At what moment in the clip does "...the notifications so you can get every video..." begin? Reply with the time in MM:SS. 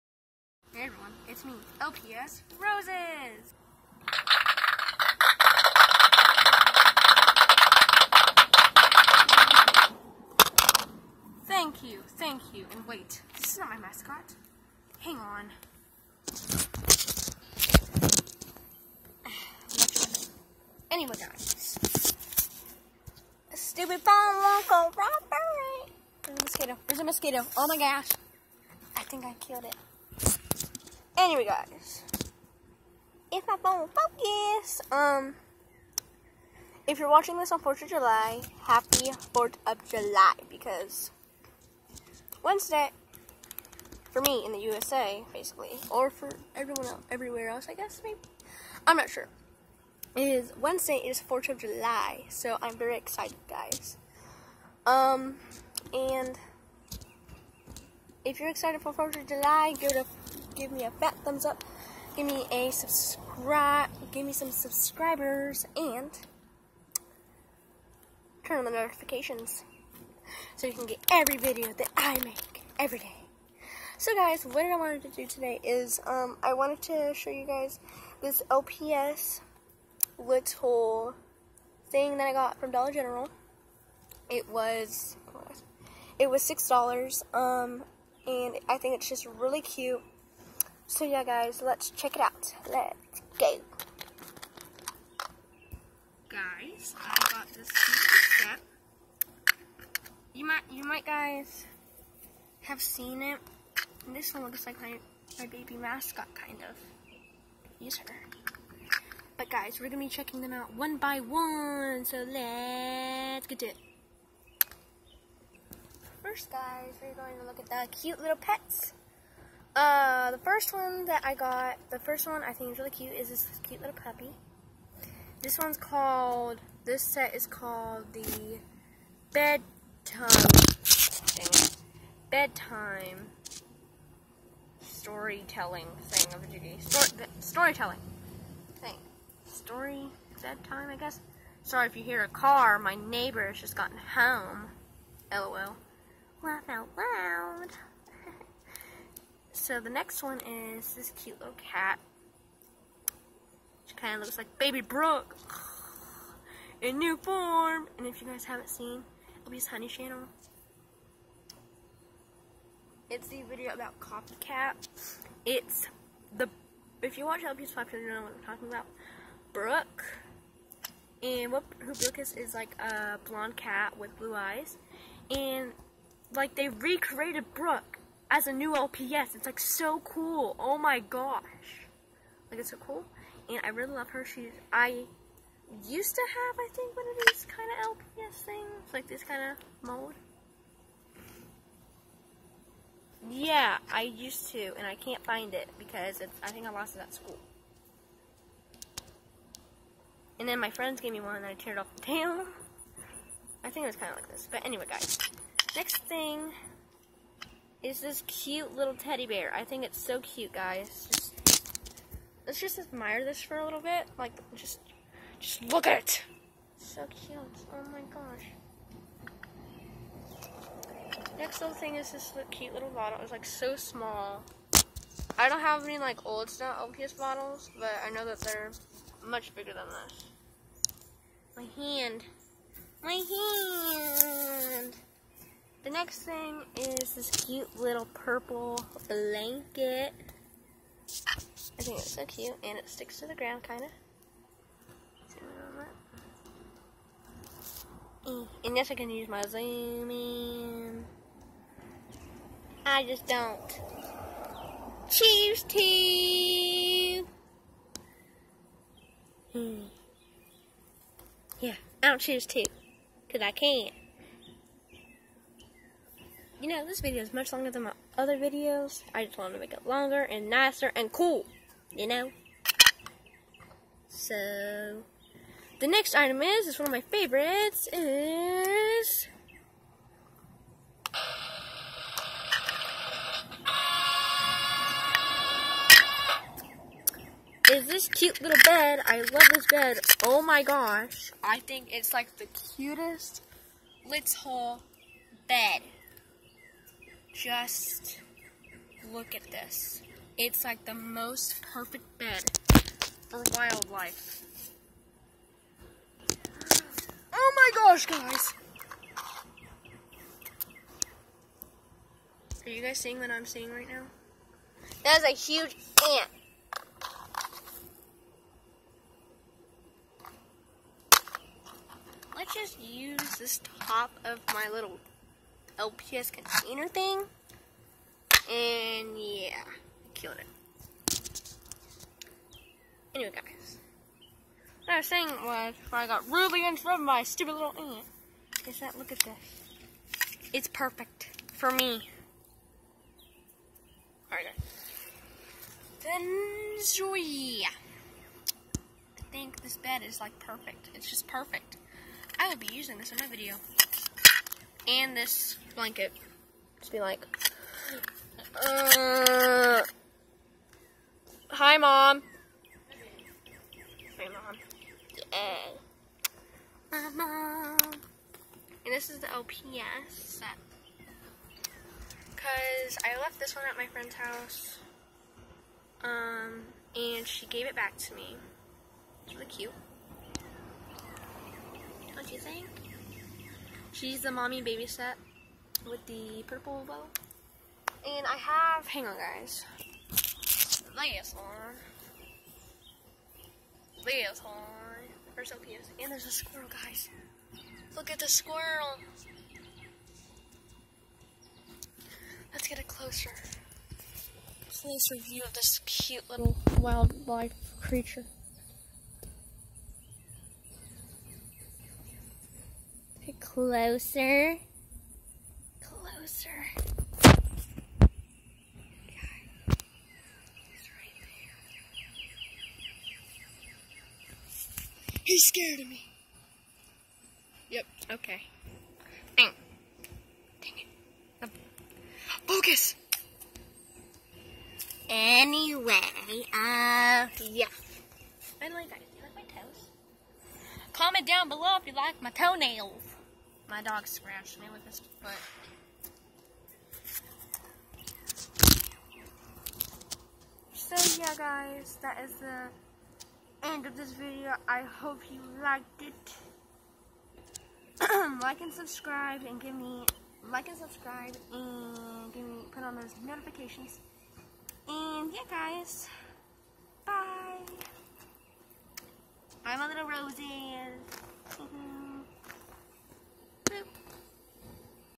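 01:08.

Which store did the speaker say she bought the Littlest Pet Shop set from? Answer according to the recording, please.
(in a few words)
Dollar General.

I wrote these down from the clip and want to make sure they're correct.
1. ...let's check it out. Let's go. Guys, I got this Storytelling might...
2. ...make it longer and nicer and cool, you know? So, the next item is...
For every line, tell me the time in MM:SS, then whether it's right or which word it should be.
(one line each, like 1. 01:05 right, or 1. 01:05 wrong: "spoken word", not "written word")
1. 01:31 wrong: "You", not "Storytelling"
2. 04:29 right.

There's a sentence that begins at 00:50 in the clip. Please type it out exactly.
It is Wednesday, it is 4th of July, so I'm very excited, guys.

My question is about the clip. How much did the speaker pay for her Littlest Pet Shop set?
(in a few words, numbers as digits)
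6 dollars.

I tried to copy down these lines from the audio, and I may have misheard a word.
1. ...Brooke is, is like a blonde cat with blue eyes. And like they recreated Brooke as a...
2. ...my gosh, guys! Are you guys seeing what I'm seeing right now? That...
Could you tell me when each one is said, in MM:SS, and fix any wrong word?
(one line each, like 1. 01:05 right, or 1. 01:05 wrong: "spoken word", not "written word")
1. 02:51 right
2. 05:07 right.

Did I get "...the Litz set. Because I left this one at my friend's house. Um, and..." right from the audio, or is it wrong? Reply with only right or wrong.
wrong.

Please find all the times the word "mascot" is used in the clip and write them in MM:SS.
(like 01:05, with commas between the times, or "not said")
00:13, 01:45.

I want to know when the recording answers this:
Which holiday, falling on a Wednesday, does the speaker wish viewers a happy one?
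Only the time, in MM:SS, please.
00:38.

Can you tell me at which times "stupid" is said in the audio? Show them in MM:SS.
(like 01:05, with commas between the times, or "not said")
00:23, 05:37.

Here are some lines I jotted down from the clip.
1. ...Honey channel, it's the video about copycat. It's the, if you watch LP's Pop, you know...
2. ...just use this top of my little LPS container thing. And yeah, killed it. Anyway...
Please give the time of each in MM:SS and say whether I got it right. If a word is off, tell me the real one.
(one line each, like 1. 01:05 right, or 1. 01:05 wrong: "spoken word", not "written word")
1. 02:39 right
2. 05:22 right.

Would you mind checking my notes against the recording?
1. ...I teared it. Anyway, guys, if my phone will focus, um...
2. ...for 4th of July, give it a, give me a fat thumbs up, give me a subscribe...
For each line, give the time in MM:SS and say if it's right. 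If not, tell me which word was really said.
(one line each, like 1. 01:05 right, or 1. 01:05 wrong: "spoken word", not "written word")
1. 00:29 wrong: "killed", not "teared"
2. 00:58 right.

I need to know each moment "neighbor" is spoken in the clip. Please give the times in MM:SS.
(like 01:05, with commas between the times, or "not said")
02:22.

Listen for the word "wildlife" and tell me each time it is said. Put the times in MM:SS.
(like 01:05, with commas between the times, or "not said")
05:03, 06:46.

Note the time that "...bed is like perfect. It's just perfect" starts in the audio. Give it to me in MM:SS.
05:49.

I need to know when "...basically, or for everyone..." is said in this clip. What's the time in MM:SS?
00:45.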